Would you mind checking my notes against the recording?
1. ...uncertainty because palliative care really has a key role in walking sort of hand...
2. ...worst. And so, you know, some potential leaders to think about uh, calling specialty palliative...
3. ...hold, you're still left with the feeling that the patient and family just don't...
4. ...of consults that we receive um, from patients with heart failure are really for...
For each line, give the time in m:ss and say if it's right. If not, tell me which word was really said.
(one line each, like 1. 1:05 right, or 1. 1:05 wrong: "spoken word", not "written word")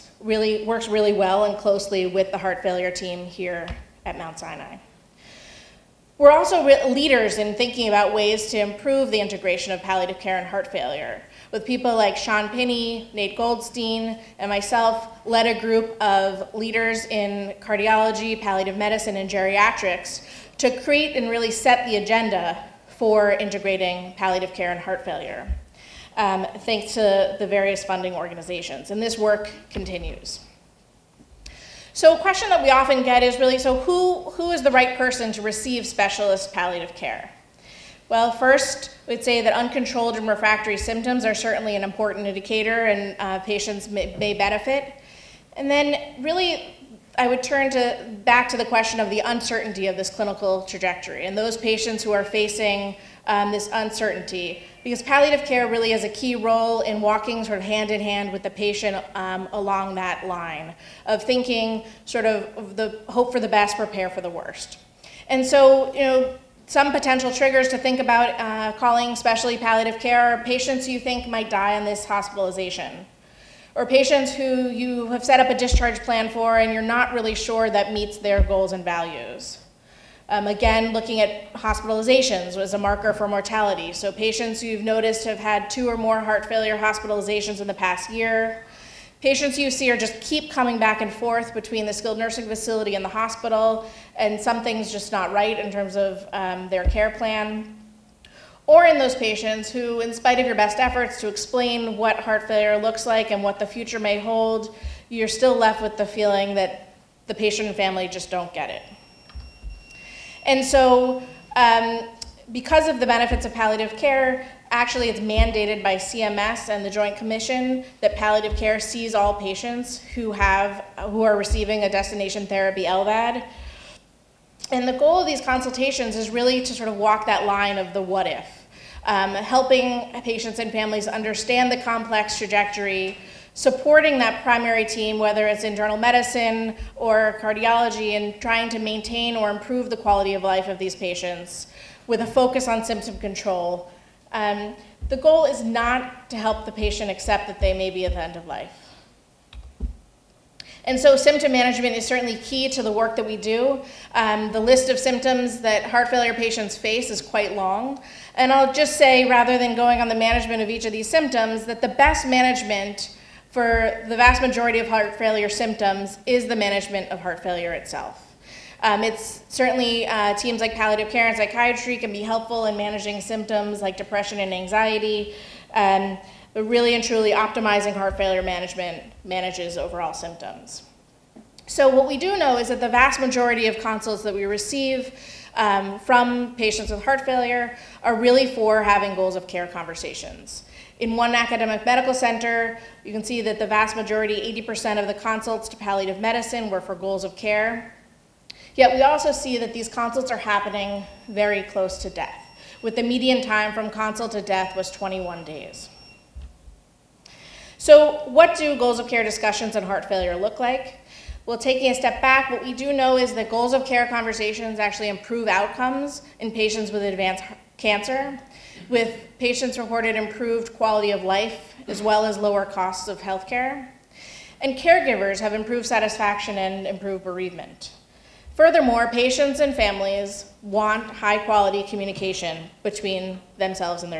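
1. 0:53 right
2. 1:04 wrong: "triggers", not "leaders"
3. 1:44 right
4. 3:03 right.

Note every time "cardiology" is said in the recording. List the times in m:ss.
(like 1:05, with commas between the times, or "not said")
0:17, 2:17.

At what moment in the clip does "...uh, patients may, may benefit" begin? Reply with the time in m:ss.
0:43.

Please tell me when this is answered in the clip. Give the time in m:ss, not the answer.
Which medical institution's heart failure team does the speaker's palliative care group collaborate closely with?
0:04.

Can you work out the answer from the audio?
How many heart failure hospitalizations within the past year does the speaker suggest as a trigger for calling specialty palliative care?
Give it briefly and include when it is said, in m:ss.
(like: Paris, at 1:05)
2 or more, at 1:25.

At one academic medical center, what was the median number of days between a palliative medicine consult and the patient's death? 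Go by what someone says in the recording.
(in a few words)
21 days.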